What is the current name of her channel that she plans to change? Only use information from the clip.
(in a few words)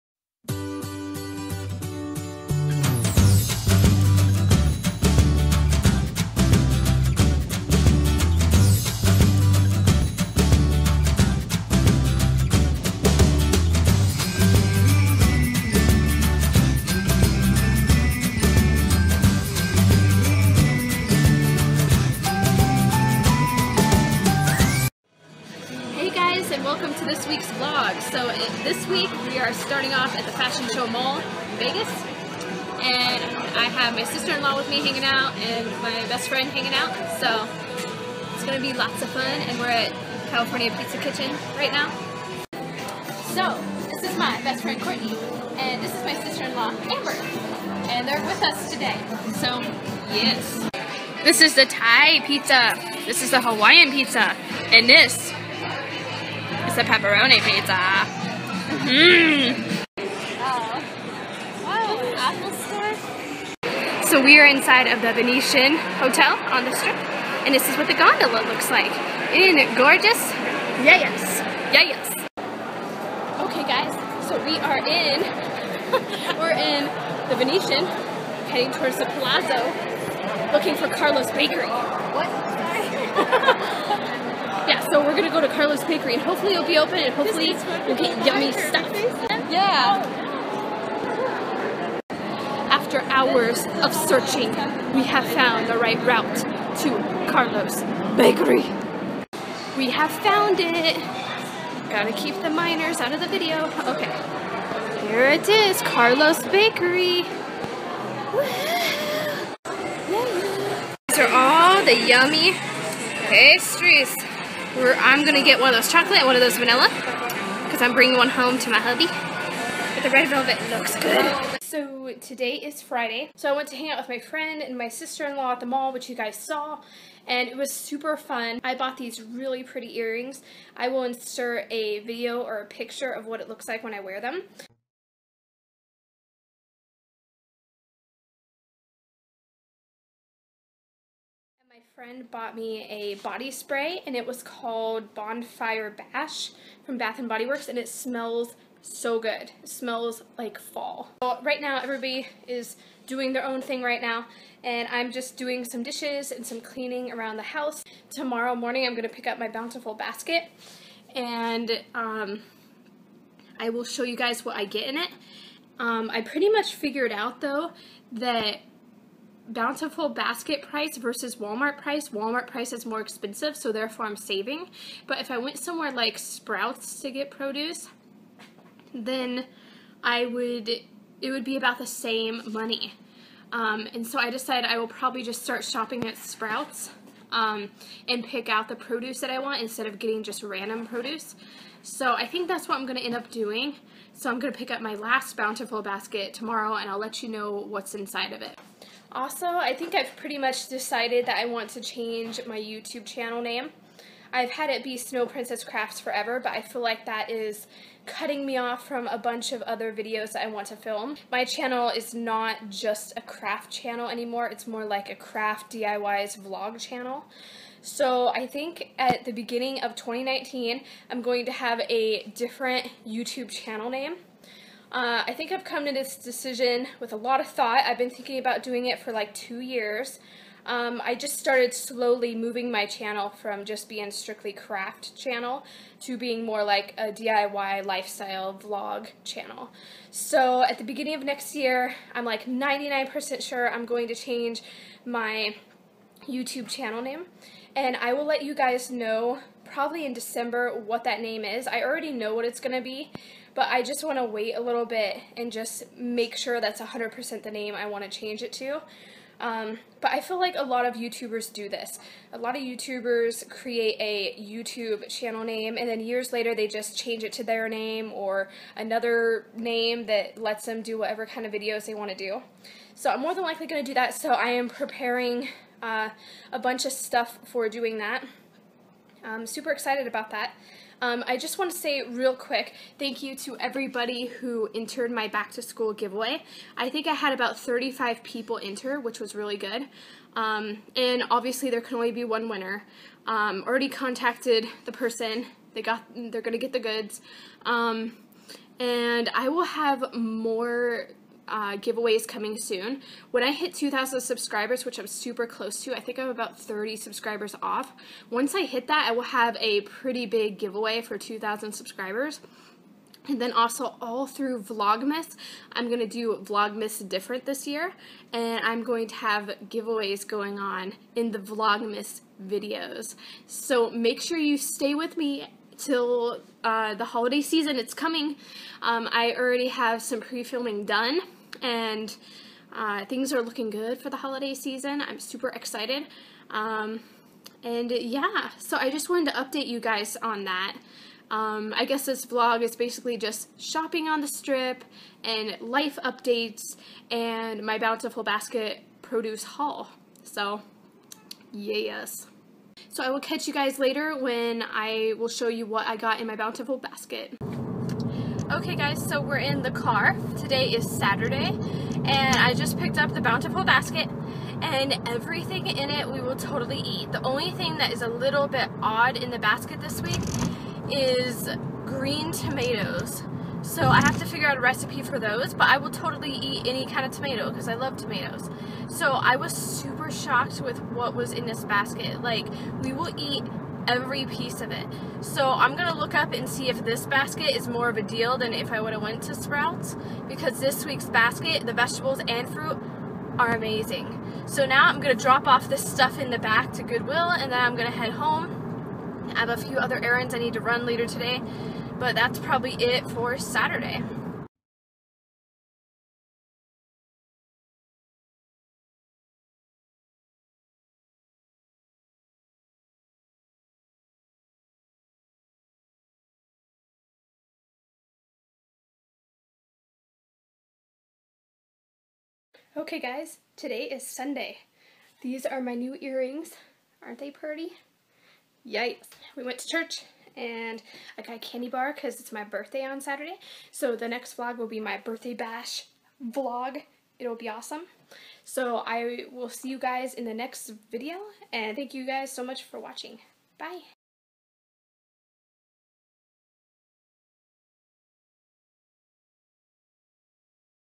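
Snow Princess Crafts.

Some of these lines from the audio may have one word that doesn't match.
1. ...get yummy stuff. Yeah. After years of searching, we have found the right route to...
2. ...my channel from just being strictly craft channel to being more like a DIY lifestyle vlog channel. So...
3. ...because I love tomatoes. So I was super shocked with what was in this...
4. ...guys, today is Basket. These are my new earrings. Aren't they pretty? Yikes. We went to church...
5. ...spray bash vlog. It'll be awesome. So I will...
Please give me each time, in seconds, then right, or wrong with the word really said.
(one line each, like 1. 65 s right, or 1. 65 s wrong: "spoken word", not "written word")
1. 87 s wrong: "hours", not "years"
2. 232 s right
3. 377 s right
4. 422 s wrong: "Sunday", not "Basket"
5. 434 s wrong: "birthday", not "spray".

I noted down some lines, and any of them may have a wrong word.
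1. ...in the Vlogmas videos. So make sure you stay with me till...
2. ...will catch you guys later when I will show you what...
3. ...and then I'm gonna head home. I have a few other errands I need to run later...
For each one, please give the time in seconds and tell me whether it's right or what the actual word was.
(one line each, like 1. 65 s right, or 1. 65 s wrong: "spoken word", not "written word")
1. 321 s right
2. 353 s right
3. 397 s right.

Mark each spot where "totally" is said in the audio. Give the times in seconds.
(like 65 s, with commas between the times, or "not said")
366 s, 375 s.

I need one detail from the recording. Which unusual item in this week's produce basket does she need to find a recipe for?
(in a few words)
Green tomatoes.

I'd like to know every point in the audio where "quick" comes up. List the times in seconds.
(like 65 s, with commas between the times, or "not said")
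282 s.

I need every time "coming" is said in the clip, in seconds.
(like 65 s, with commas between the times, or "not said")
302 s, 327 s.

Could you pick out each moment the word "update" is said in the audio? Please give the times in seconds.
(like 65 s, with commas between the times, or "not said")
339 s, 346 s.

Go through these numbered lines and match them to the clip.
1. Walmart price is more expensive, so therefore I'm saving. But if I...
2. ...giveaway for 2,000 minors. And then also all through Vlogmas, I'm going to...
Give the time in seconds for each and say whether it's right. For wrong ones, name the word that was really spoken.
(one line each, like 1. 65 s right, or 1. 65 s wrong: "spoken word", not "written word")
1. 172 s right
2. 310 s wrong: "subscribers", not "minors".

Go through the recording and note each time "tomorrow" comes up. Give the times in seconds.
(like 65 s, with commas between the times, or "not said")
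158 s, 196 s.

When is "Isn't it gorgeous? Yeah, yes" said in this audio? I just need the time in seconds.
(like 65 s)
69 s.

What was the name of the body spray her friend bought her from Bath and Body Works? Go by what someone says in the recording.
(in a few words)
Bonfire Bash.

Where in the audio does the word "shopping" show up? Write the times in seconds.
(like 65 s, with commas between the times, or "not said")
185 s, 343 s.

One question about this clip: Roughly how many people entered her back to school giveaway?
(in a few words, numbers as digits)
35.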